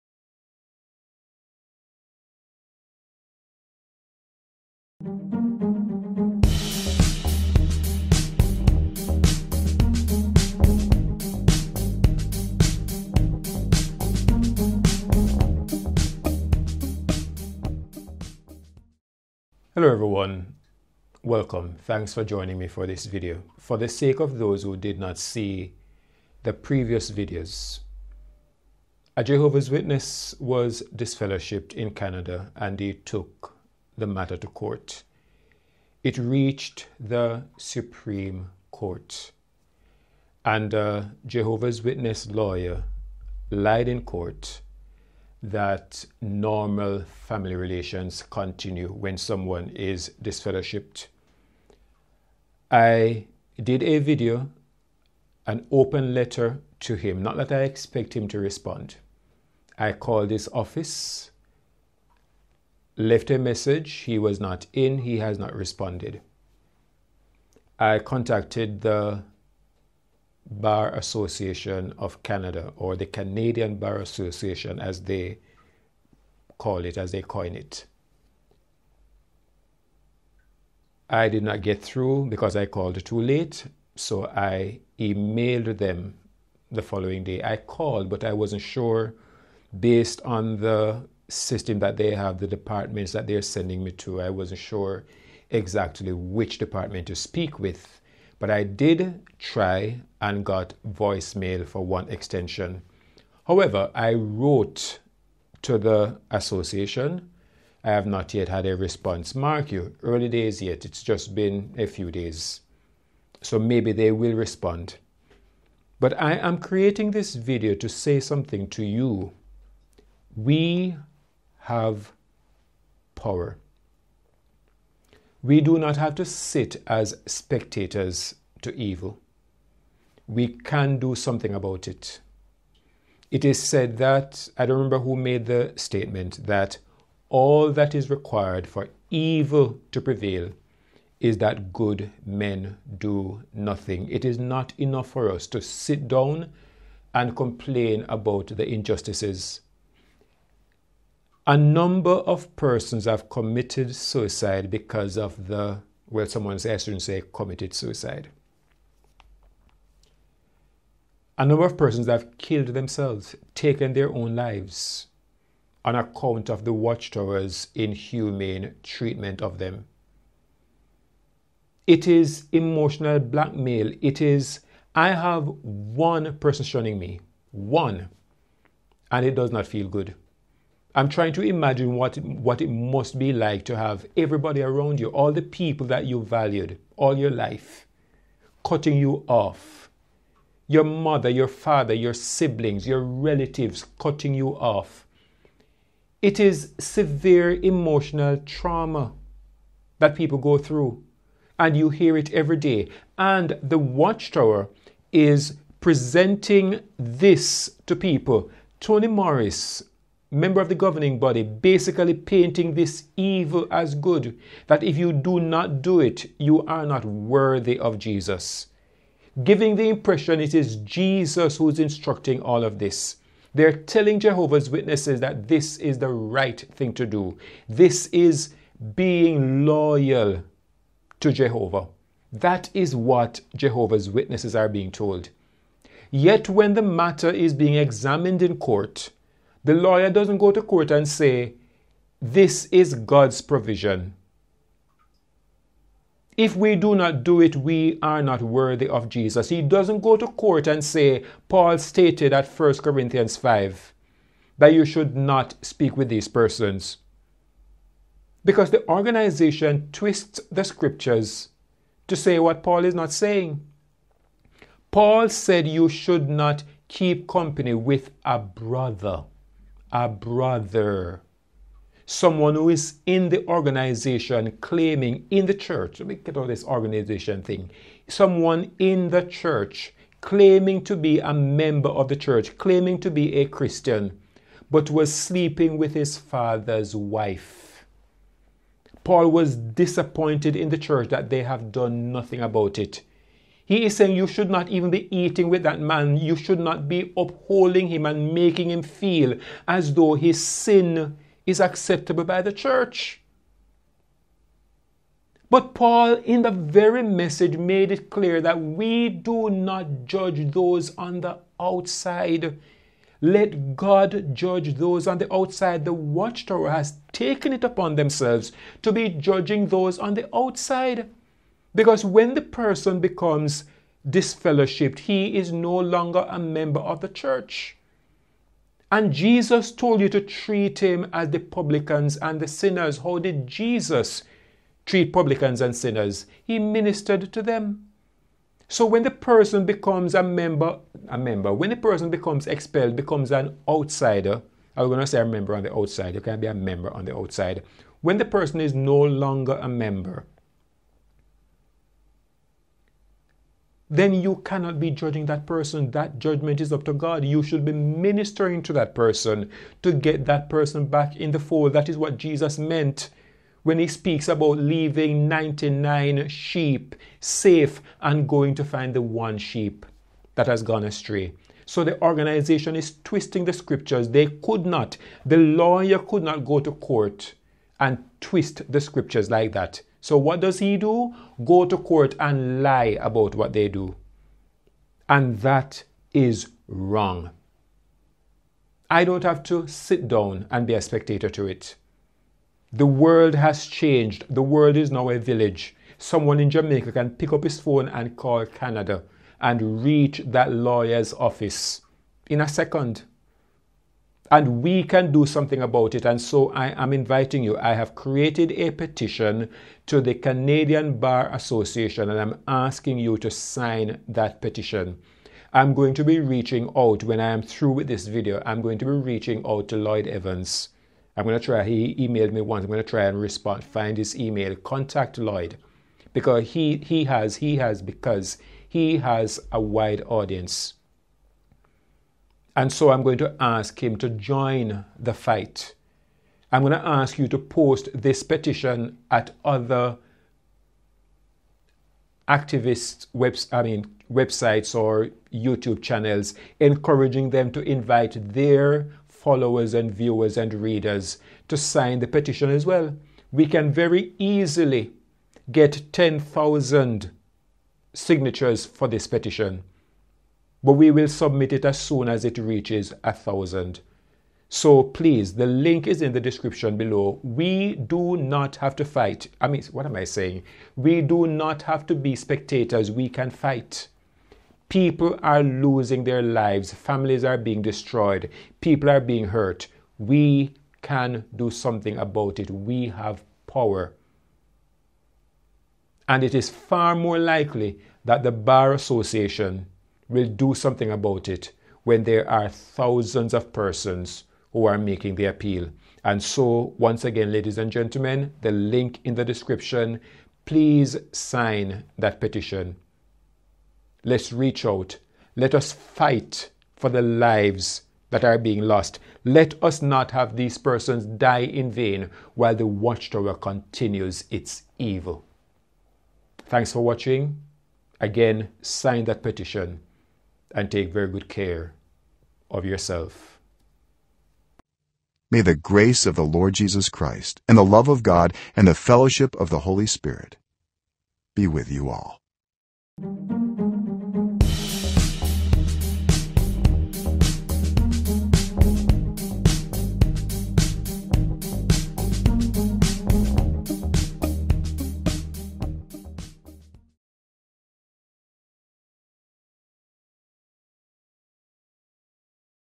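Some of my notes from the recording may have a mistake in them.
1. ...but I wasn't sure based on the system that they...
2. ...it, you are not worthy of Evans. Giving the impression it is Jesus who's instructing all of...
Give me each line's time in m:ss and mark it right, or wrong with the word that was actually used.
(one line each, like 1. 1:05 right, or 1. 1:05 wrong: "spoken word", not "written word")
1. 1:28 right
2. 3:35 wrong: "Jesus", not "Evans".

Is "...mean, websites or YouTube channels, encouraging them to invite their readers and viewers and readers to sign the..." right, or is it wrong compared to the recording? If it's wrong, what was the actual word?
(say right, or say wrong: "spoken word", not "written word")
wrong: "followers", not "readers".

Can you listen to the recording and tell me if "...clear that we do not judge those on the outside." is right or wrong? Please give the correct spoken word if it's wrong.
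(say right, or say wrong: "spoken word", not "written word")
right.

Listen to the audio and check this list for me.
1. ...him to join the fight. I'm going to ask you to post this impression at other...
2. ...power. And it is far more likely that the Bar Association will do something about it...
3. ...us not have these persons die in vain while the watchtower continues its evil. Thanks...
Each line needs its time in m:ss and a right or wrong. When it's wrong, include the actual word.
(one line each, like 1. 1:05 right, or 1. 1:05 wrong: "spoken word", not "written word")
1. 7:13 wrong: "petition", not "impression"
2. 8:03 right
3. 8:29 right.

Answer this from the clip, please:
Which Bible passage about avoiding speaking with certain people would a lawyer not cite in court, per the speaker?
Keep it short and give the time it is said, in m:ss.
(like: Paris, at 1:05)
1 Corinthians 5, at 4:12.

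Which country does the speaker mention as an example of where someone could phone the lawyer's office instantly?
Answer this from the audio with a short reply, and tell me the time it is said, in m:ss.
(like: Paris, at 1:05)
Jamaica, at 6:36.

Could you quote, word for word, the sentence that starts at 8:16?
And so, once again, ladies and gentlemen, the link in the description, please sign that petition.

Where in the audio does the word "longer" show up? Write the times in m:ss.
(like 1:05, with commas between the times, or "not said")
5:25, 5:48.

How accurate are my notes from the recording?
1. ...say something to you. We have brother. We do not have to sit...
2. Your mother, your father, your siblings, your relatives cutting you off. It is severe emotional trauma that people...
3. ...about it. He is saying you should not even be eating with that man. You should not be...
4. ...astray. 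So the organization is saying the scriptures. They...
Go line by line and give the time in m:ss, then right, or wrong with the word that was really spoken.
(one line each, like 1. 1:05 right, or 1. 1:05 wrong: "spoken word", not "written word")
1. 1:57 wrong: "power", not "brother"
2. 3:10 right
3. 4:52 right
4. 6:10 wrong: "twisting", not "saying".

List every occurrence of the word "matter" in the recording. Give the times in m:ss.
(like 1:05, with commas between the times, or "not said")
0:34, 3:56.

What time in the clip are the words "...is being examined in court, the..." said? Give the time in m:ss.
3:57.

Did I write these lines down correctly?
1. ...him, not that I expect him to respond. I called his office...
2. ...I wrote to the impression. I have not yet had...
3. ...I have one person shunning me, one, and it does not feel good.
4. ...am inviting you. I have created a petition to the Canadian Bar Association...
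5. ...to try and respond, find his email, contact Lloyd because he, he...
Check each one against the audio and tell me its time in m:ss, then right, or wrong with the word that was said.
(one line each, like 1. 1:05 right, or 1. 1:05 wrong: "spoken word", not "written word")
1. 0:56 right
2. 1:43 wrong: "association", not "impression"
3. 2:54 right
4. 6:46 right
5. 7:02 right.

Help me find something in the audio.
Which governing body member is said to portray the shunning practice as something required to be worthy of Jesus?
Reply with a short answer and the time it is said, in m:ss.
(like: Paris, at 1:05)
Tony Morris, at 3:28.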